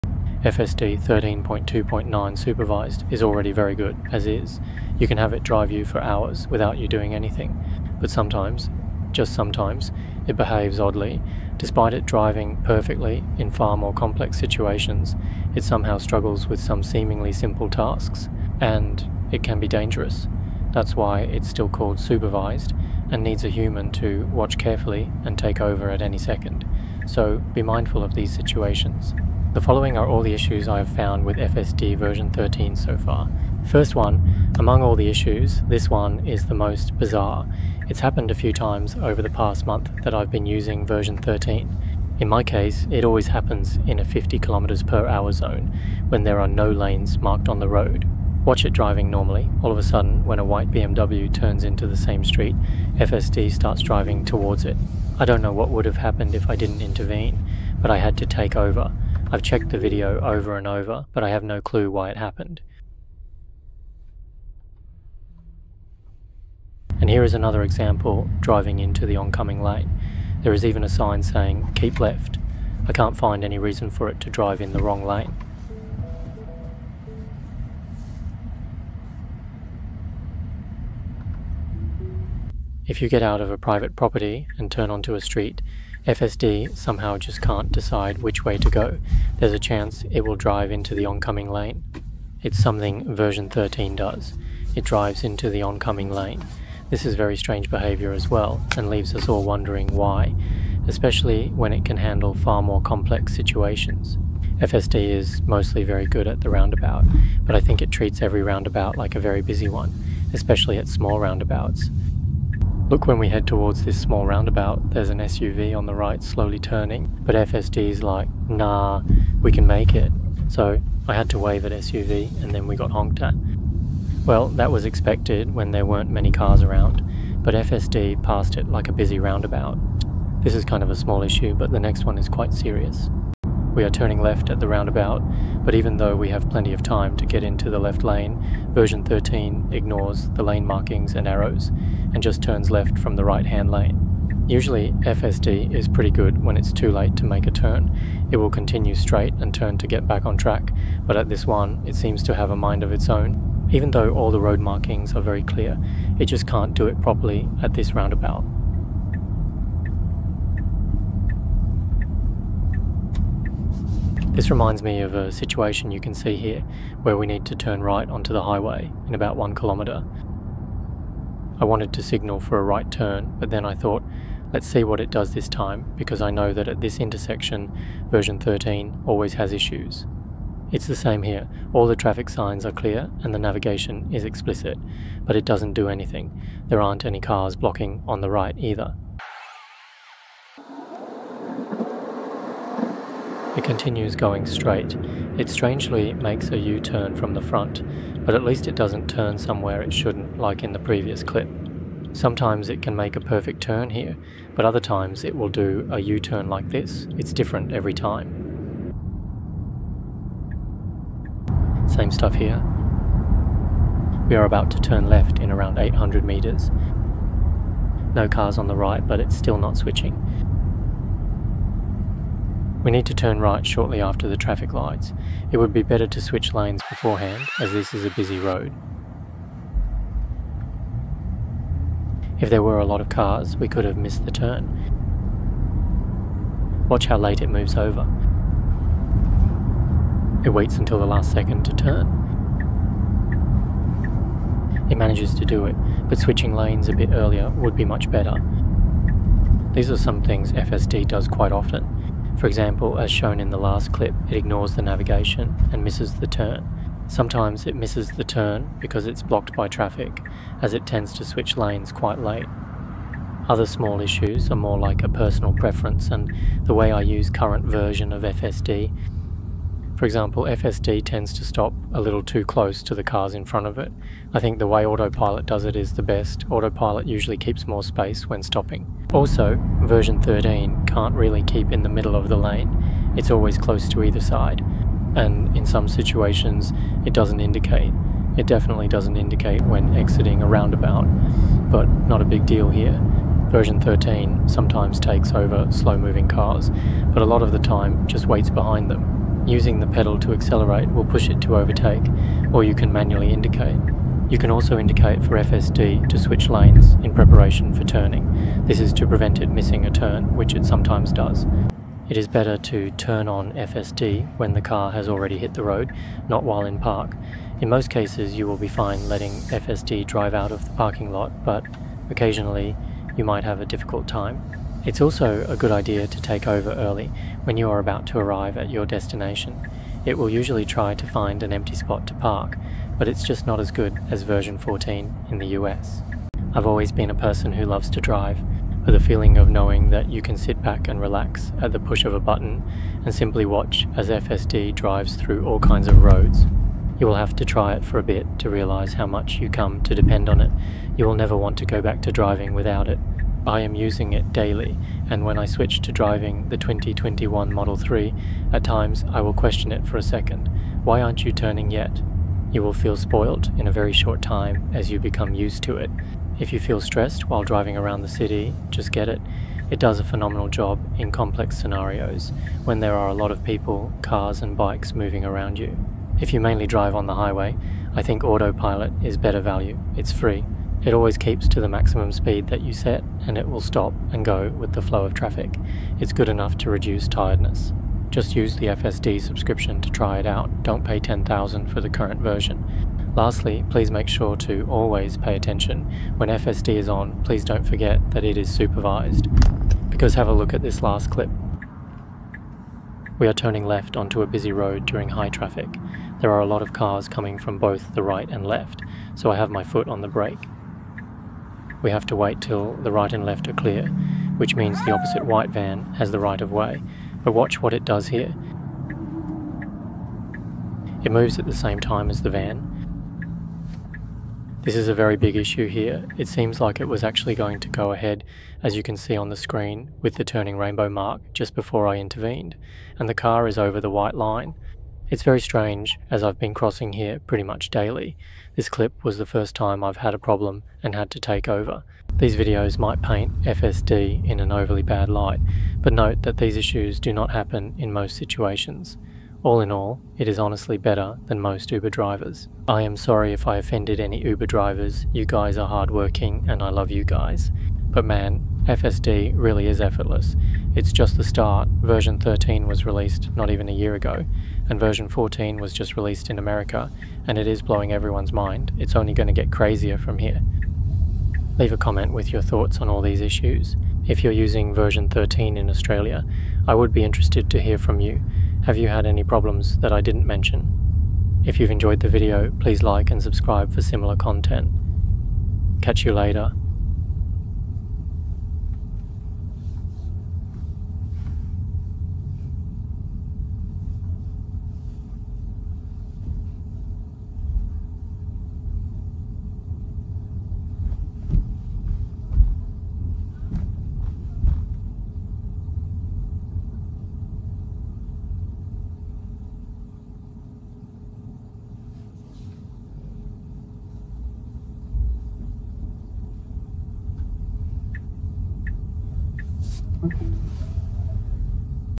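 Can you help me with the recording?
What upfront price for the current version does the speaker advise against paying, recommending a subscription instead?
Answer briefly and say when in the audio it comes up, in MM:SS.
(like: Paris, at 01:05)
10,000, at 06:30.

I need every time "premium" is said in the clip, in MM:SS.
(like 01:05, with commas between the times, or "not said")
not said.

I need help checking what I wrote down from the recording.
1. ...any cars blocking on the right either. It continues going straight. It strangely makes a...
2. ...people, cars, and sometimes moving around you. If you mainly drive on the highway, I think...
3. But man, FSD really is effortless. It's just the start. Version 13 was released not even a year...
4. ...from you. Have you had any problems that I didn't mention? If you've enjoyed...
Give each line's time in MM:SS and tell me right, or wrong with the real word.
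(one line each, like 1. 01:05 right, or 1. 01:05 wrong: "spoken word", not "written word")
1. 03:07 right
2. 06:13 wrong: "bikes", not "sometimes"
3. 07:37 right
4. 07:57 right.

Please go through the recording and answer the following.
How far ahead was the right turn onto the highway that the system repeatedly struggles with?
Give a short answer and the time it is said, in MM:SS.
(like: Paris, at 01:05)
1 kilometre, at 02:49.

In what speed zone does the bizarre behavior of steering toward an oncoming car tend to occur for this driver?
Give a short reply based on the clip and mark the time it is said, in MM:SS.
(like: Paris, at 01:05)
50 km/h, at 00:44.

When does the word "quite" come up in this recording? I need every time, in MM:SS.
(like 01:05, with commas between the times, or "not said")
02:12, 04:11, 04:21.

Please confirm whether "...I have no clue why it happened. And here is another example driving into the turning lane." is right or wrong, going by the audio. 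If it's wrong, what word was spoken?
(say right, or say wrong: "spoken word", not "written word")
wrong: "oncoming", not "turning".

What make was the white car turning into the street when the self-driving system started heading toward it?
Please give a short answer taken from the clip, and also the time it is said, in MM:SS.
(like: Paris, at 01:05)
BMW, at 00:50.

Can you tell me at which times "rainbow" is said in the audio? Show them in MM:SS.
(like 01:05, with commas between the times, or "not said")
07:10.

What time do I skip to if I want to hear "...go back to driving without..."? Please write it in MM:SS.
05:51.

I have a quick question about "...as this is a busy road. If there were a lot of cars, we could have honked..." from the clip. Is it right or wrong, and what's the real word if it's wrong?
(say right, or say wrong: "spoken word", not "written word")
wrong: "missed", not "honked".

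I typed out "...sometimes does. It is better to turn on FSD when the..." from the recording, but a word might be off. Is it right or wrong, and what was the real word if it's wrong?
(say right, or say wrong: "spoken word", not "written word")
right.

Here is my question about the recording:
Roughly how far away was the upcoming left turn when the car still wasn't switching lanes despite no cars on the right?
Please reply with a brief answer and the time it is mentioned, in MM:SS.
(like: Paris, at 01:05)
800 metres, at 03:35.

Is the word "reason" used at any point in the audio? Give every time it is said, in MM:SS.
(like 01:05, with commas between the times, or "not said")
01:13.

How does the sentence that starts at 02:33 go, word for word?
Even though all the road markings are very clear, it just can't do it properly at this roundabout.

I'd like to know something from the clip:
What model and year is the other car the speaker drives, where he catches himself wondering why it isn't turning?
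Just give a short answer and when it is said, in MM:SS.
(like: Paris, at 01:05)
2021 Model 3, at 05:56.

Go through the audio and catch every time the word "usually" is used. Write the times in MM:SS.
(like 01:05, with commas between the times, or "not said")
02:24, 04:37, 05:30.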